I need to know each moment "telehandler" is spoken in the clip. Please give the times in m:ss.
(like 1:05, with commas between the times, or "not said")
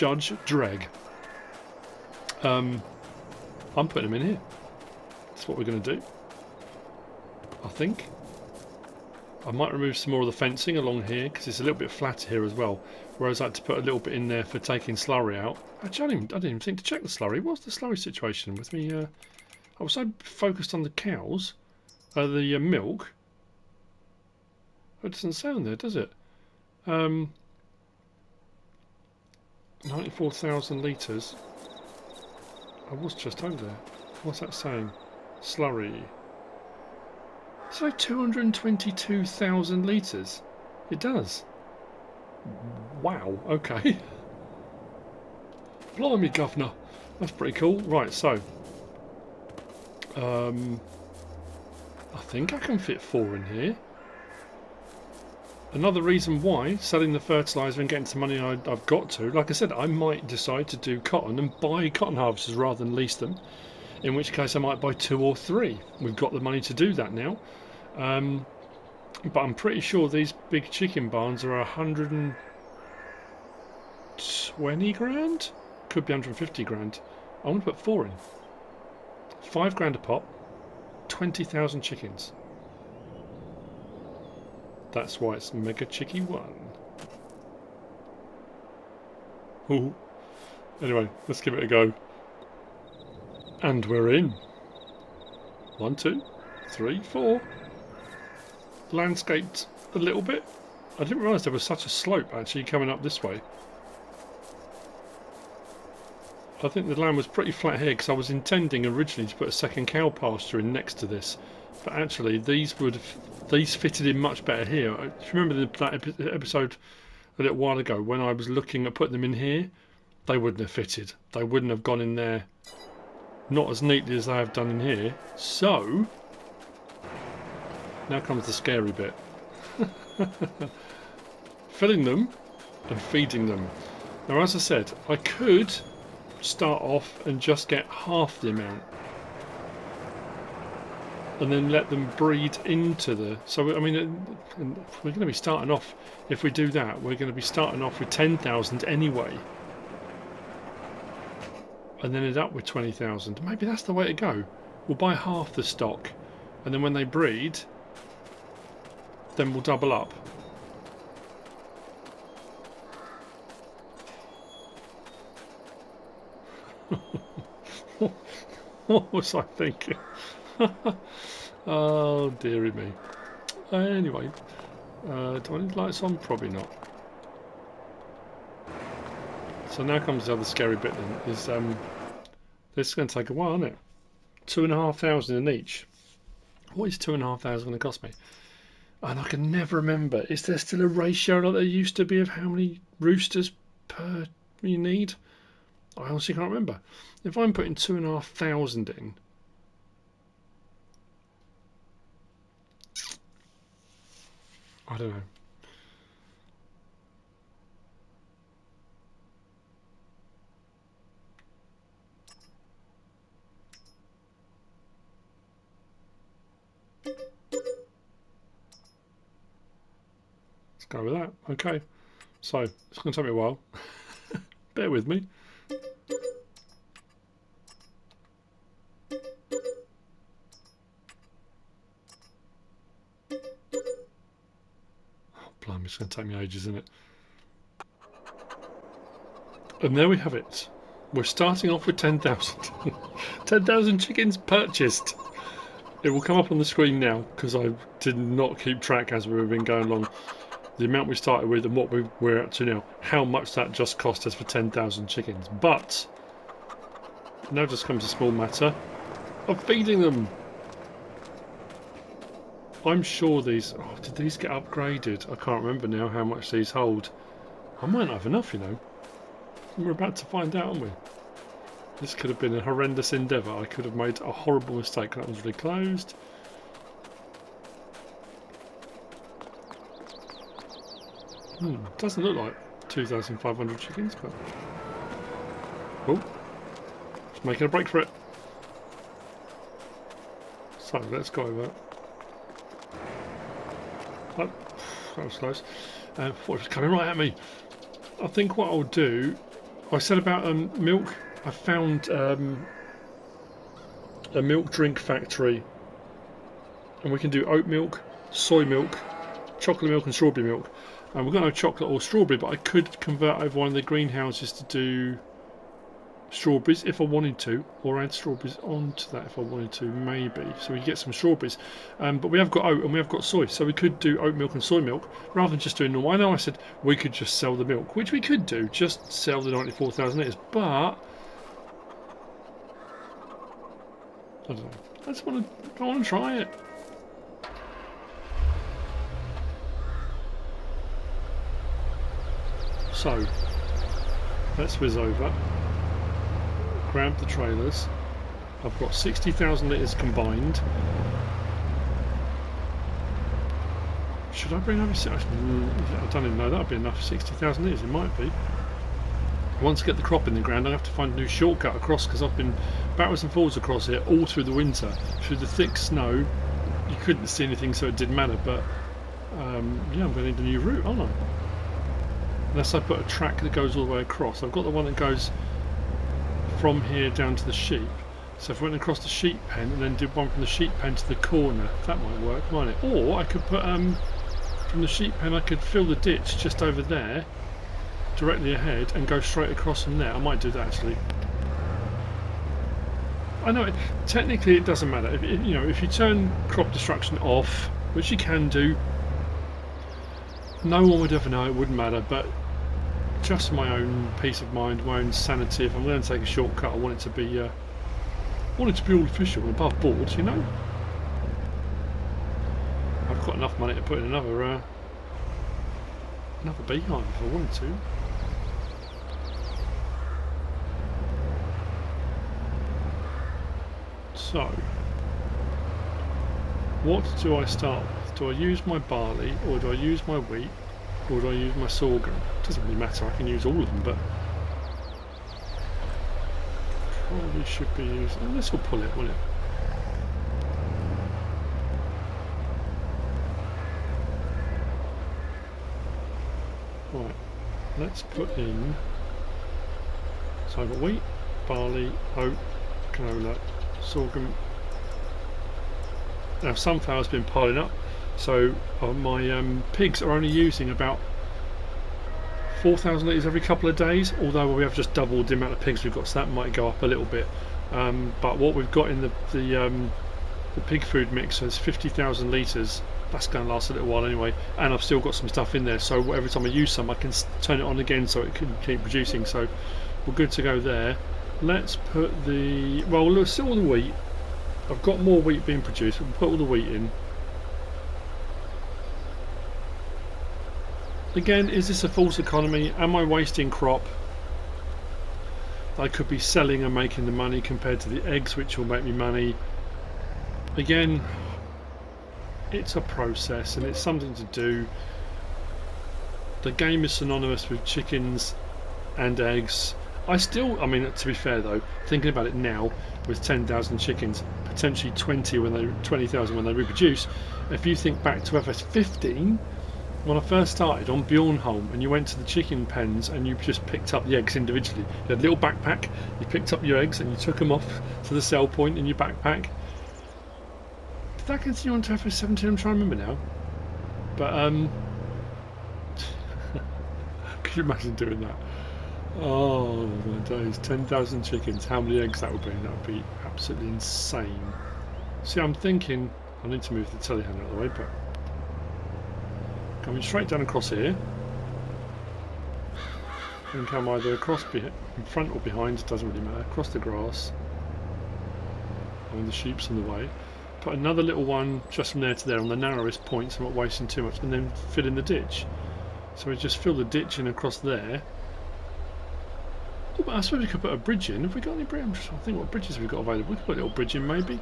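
9:06.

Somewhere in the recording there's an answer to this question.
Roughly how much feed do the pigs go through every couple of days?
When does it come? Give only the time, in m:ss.
7:42.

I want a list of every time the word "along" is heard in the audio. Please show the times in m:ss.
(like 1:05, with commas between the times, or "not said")
0:10, 4:09.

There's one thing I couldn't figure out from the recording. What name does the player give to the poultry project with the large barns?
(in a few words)
Mega Chicky 1.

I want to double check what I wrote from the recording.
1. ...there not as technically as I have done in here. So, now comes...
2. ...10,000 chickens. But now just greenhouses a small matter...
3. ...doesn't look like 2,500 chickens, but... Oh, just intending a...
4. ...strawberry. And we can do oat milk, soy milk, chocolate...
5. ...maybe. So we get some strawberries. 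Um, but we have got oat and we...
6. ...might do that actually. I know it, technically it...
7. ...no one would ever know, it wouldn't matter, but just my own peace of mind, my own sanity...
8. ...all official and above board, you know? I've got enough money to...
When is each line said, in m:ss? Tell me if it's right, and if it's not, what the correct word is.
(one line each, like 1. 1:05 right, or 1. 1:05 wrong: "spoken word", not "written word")
1. 2:02 wrong: "neatly", not "technically"
2. 4:14 wrong: "comes", not "greenhouses"
3. 4:41 wrong: "making", not "intending"
4. 5:04 wrong: "factory", not "strawberry"
5. 5:19 right
6. 6:30 right
7. 6:40 right
8. 6:48 right.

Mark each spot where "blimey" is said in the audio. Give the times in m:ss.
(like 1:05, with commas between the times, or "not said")
0:45, 3:55.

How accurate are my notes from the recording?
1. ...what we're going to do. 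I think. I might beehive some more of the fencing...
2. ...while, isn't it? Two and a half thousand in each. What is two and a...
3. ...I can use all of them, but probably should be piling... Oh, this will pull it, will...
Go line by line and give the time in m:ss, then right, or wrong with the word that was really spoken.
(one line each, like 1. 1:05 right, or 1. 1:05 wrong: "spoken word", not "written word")
1. 0:05 wrong: "remove", not "beehive"
2. 3:03 right
3. 7:13 wrong: "using", not "piling".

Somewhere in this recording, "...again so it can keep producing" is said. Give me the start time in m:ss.
7:57.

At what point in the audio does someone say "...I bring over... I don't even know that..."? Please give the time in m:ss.
5:54.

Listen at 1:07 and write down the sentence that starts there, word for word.
Um, but I'm pretty sure these big chicken barns are 120 grand?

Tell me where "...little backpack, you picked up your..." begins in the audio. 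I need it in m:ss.
8:45.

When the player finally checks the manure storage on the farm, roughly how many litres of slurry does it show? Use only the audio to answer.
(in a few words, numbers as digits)
222,000 litres.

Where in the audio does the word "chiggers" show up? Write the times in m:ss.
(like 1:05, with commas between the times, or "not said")
not said.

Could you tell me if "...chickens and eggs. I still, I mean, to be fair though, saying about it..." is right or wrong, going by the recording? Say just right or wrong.
wrong.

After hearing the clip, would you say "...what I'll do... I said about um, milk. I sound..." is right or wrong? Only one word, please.
wrong.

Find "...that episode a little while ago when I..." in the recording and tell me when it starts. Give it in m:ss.
1:55.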